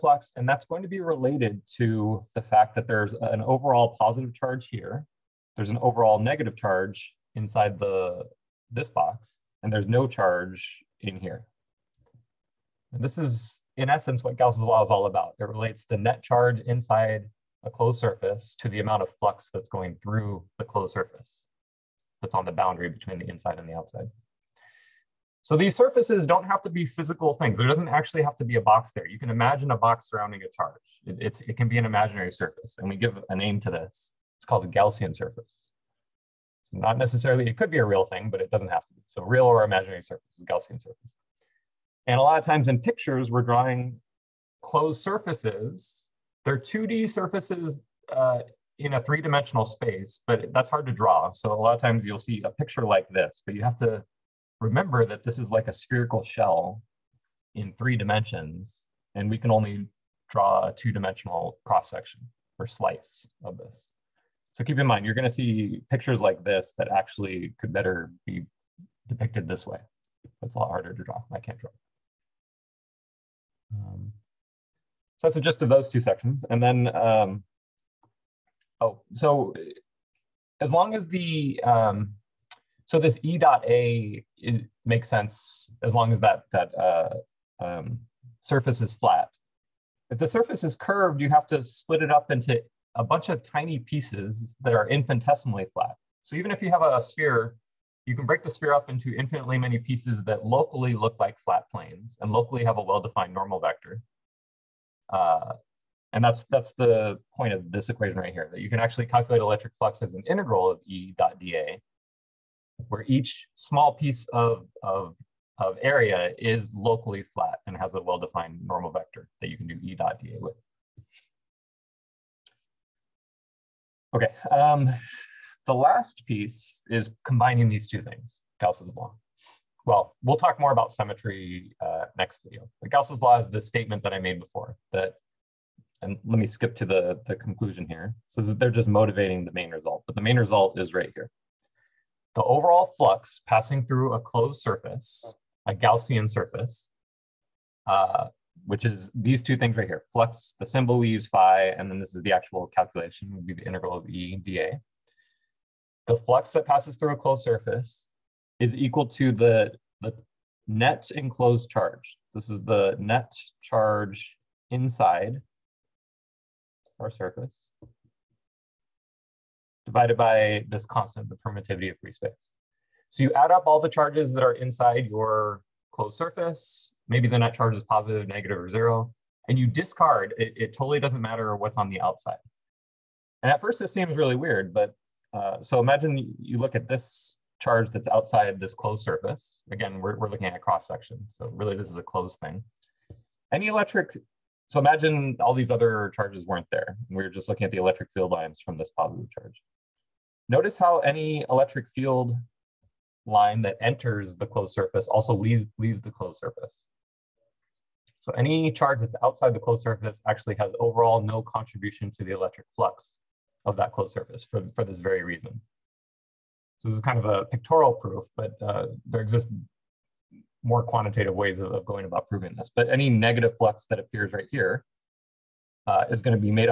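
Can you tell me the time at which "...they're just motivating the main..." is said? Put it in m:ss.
2:18.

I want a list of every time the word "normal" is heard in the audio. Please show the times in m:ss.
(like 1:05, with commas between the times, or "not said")
1:43, 1:58.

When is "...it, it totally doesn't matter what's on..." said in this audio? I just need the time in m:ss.
3:00.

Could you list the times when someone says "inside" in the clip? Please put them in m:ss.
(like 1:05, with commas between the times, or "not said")
0:07, 0:16, 0:23, 2:44, 2:54.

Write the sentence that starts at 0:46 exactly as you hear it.
They're 2D surfaces uh, in a three-dimensional space, but that's hard to draw.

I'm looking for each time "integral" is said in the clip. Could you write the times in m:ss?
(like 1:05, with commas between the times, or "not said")
1:50, 2:33.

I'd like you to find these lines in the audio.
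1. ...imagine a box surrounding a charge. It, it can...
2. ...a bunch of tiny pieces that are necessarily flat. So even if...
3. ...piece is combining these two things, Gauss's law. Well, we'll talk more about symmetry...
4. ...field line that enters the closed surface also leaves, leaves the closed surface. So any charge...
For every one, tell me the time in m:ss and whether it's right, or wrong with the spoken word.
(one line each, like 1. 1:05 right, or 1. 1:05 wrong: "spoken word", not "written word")
1. 0:29 right
2. 1:32 wrong: "infinitesimally", not "necessarily"
3. 2:06 right
4. 3:21 right.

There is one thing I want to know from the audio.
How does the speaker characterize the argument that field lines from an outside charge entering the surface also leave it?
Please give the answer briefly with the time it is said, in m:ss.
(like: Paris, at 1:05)
a pictorial proof, at 3:37.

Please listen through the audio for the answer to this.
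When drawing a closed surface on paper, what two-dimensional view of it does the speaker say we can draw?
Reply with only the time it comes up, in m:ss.
1:01.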